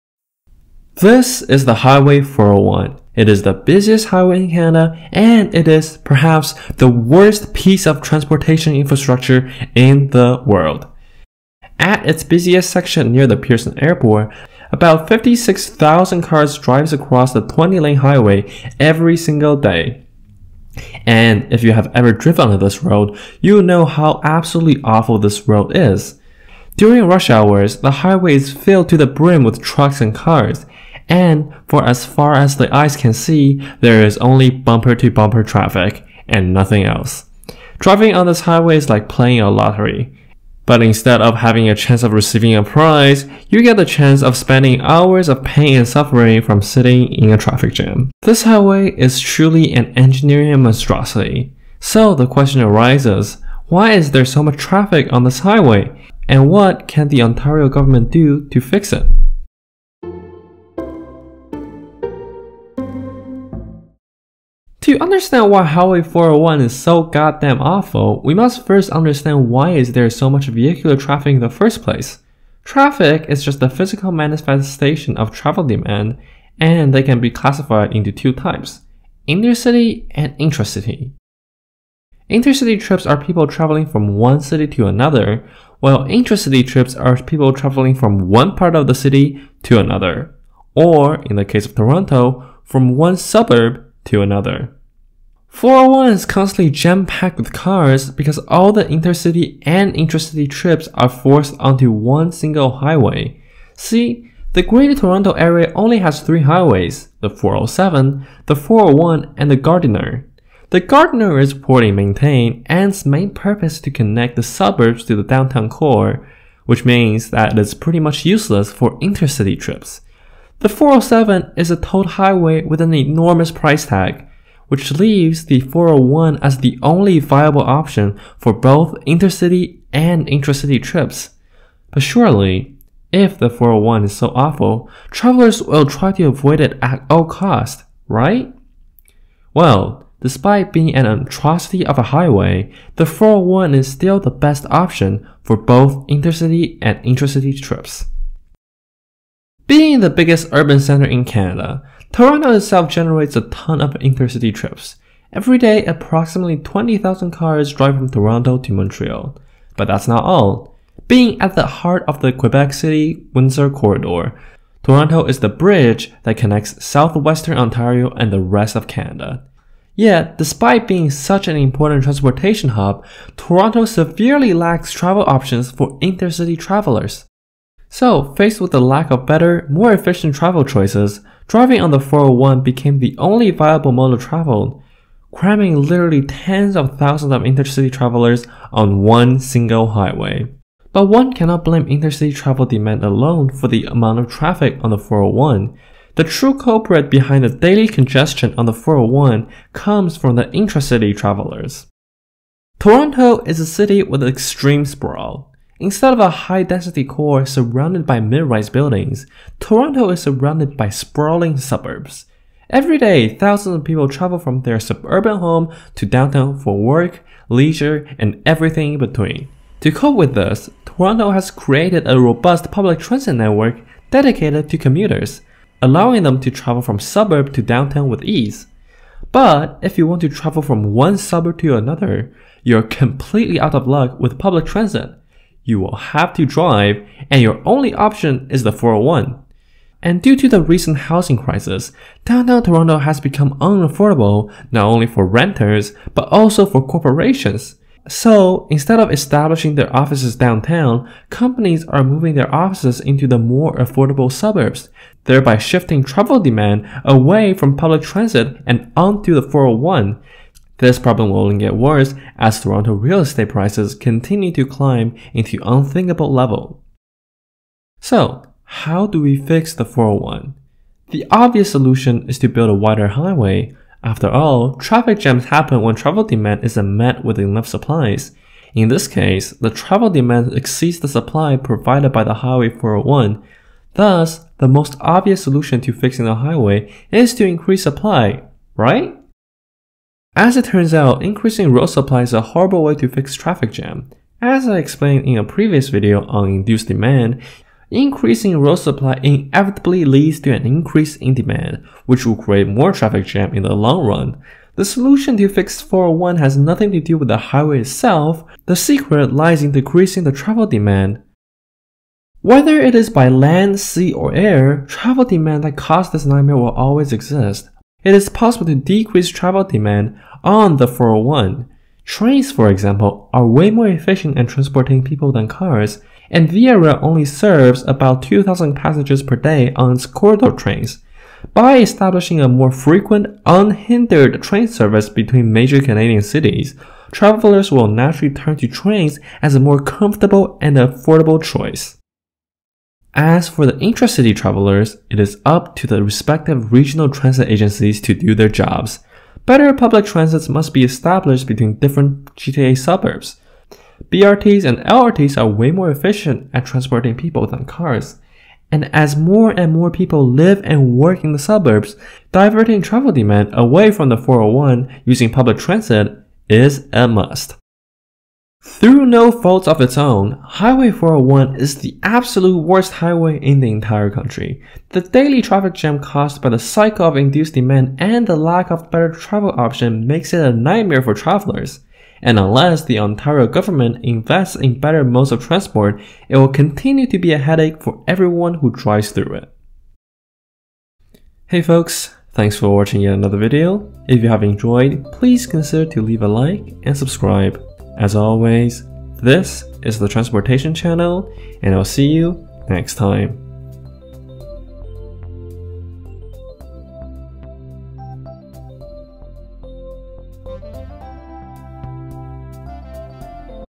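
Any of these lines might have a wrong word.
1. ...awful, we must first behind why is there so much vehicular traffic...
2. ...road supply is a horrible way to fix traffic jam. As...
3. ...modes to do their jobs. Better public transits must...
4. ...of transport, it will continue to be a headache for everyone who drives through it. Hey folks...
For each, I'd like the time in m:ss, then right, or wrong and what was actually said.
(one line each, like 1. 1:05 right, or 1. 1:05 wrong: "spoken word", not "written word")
1. 1:07 wrong: "understand", not "behind"
2. 4:51 right
3. 5:47 wrong: "agencies", not "modes"
4. 6:25 right.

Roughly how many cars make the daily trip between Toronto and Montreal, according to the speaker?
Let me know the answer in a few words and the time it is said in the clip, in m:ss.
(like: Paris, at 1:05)
20,000, at 2:36.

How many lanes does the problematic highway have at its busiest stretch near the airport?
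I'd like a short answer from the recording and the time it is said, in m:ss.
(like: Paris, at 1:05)
20, at 0:17.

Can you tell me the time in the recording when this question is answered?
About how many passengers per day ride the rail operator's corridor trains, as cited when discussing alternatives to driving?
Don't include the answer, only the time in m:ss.
5:28.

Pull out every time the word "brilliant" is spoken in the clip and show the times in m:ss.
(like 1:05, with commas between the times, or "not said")
not said.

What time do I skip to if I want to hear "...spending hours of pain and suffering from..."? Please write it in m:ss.
0:44.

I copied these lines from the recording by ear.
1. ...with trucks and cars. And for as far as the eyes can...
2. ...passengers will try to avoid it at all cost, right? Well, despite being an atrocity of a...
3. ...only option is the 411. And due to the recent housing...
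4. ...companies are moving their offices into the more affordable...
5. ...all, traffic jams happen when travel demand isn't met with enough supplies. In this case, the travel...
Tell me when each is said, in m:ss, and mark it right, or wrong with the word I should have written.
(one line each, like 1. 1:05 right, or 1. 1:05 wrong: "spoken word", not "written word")
1. 0:29 right
2. 2:15 wrong: "travelers", not "passengers"
3. 3:57 wrong: "401", not "411"
4. 4:11 right
5. 4:34 right.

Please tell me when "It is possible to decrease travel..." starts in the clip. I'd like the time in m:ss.
5:18.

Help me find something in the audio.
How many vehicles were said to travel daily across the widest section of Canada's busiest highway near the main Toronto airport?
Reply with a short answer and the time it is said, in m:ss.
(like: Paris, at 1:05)
56,000, at 0:15.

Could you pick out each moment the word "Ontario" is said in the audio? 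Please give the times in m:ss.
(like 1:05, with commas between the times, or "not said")
0:57, 2:47, 6:22.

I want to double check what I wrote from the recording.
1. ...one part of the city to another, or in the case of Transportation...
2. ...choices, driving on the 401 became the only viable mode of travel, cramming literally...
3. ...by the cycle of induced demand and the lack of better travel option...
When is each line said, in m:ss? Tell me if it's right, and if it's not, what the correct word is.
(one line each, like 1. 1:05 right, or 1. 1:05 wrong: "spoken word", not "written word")
1. 1:28 wrong: "Toronto", not "Transportation"
2. 3:00 right
3. 6:16 right.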